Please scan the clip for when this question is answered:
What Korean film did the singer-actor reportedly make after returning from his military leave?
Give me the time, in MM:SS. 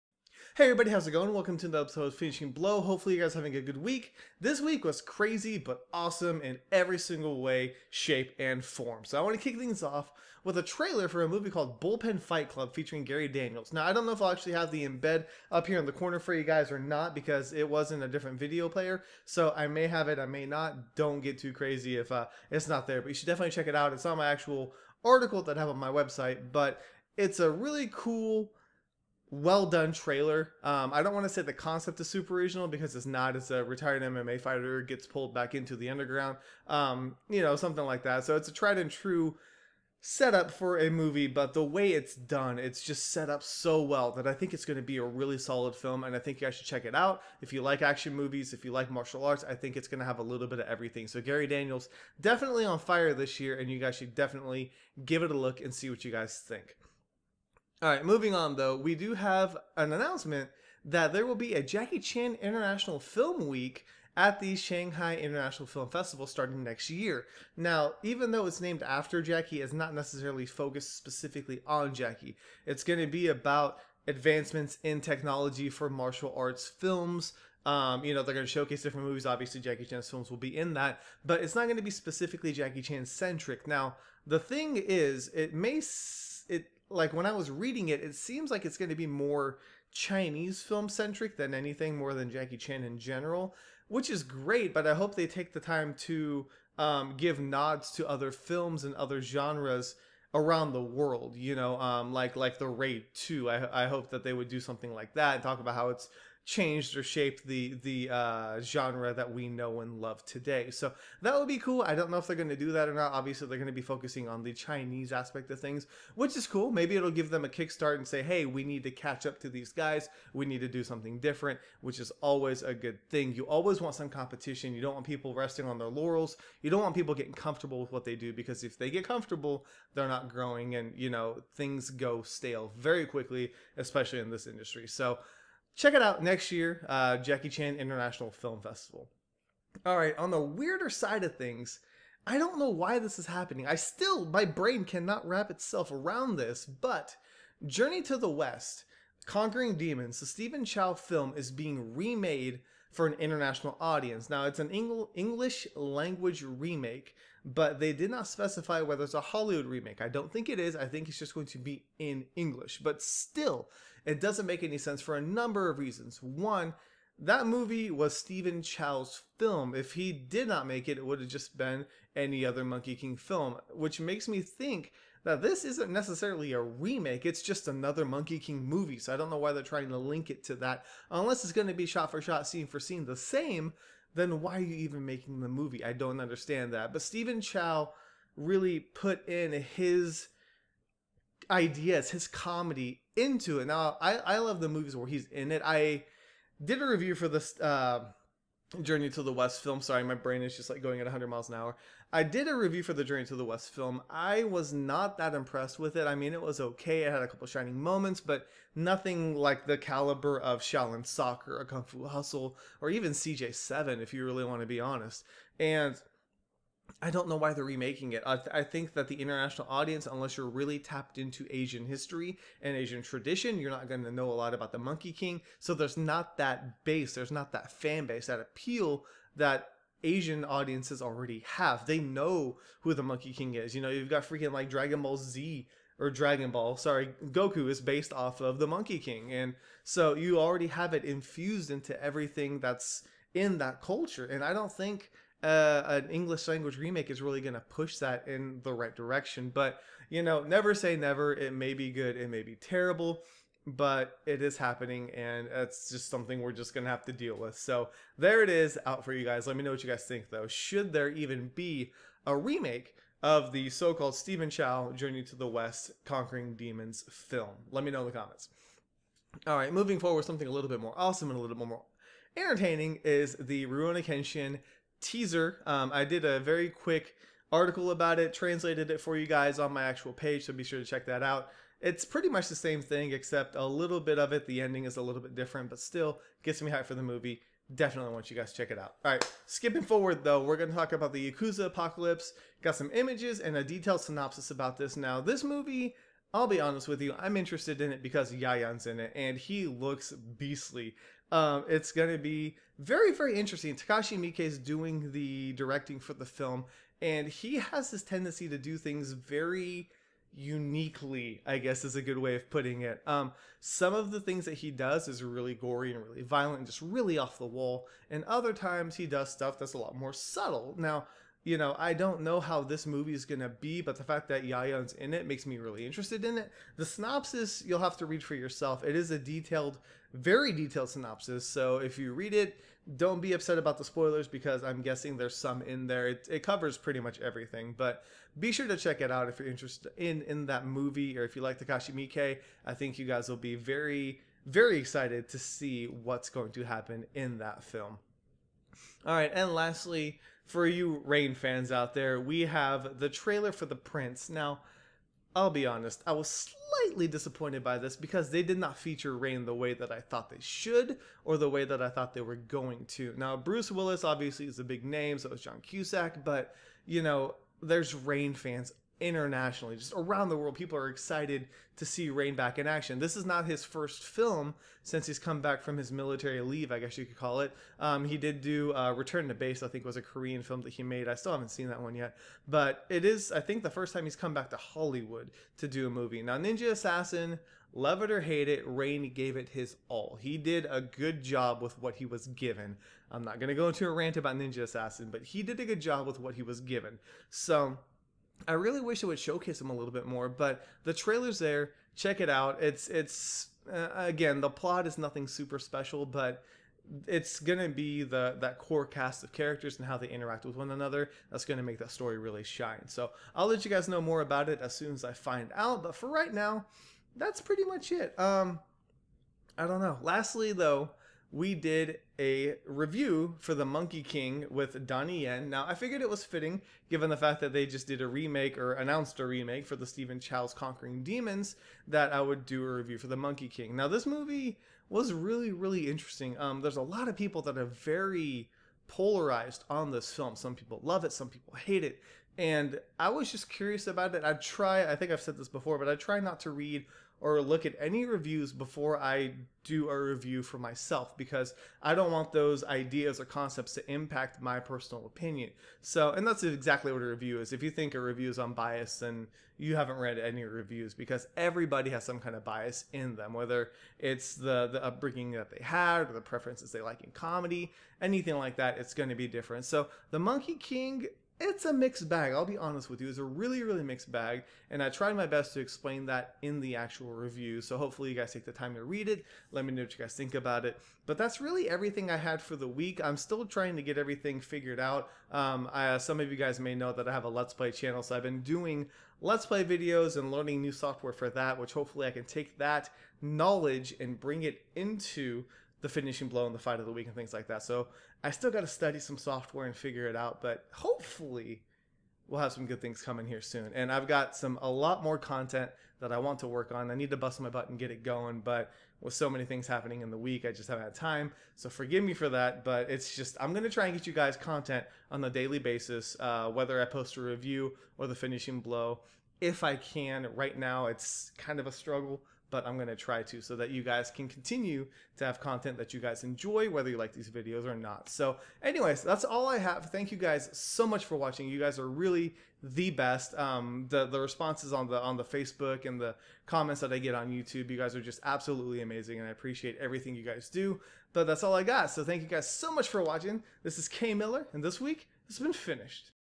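06:18.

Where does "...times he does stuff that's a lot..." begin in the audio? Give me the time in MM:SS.
05:18.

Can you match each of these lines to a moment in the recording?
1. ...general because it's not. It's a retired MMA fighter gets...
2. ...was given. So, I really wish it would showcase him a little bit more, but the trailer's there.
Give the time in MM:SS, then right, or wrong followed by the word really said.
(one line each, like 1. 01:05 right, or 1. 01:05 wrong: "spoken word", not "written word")
1. 00:32 wrong: "original", not "general"
2. 06:36 right.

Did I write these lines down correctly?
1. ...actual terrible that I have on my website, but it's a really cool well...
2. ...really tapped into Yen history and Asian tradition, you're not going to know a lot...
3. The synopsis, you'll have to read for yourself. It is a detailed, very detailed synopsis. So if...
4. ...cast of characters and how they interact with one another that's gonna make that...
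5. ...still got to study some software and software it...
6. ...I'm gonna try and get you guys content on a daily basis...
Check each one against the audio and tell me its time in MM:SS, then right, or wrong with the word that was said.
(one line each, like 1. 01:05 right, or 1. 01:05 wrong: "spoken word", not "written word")
1. 00:24 wrong: "article", not "terrible"
2. 03:40 wrong: "Asian", not "Yen"
3. 05:26 right
4. 06:48 right
5. 08:18 wrong: "figure", not "software"
6. 08:33 right.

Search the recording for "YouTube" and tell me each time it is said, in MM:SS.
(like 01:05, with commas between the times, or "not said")
08:57.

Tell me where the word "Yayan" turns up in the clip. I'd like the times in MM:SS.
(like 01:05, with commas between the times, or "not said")
04:58, 05:24.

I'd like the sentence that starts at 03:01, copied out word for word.
Unless it's going to be shot for shot, scene for scene the same, then why are you even making the movie?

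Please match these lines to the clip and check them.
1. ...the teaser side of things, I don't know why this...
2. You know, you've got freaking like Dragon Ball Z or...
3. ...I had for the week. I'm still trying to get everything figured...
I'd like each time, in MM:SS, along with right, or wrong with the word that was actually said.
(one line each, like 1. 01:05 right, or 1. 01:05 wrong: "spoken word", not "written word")
1. 02:20 wrong: "weirder", not "teaser"
2. 03:53 right
3. 08:02 right.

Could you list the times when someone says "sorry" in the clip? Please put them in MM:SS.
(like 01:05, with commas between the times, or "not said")
03:19, 03:56.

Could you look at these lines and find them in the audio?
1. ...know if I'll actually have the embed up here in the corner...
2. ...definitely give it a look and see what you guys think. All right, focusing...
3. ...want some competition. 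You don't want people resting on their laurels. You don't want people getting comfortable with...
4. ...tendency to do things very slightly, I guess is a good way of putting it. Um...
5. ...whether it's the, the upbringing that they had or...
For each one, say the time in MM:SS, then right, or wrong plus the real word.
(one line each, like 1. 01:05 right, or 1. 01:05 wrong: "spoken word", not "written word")
1. 00:14 right
2. 00:54 wrong: "moving", not "focusing"
3. 02:03 right
4. 05:08 wrong: "uniquely", not "slightly"
5. 07:43 right.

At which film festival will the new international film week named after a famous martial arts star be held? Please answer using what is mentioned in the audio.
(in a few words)
Shanghai International Film Festival.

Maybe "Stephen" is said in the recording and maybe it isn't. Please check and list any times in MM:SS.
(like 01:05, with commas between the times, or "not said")
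02:30, 02:48, 03:07, 04:24, 07:09.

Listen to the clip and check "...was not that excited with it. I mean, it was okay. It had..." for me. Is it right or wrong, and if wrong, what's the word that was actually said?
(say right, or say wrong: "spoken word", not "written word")
wrong: "impressed", not "excited".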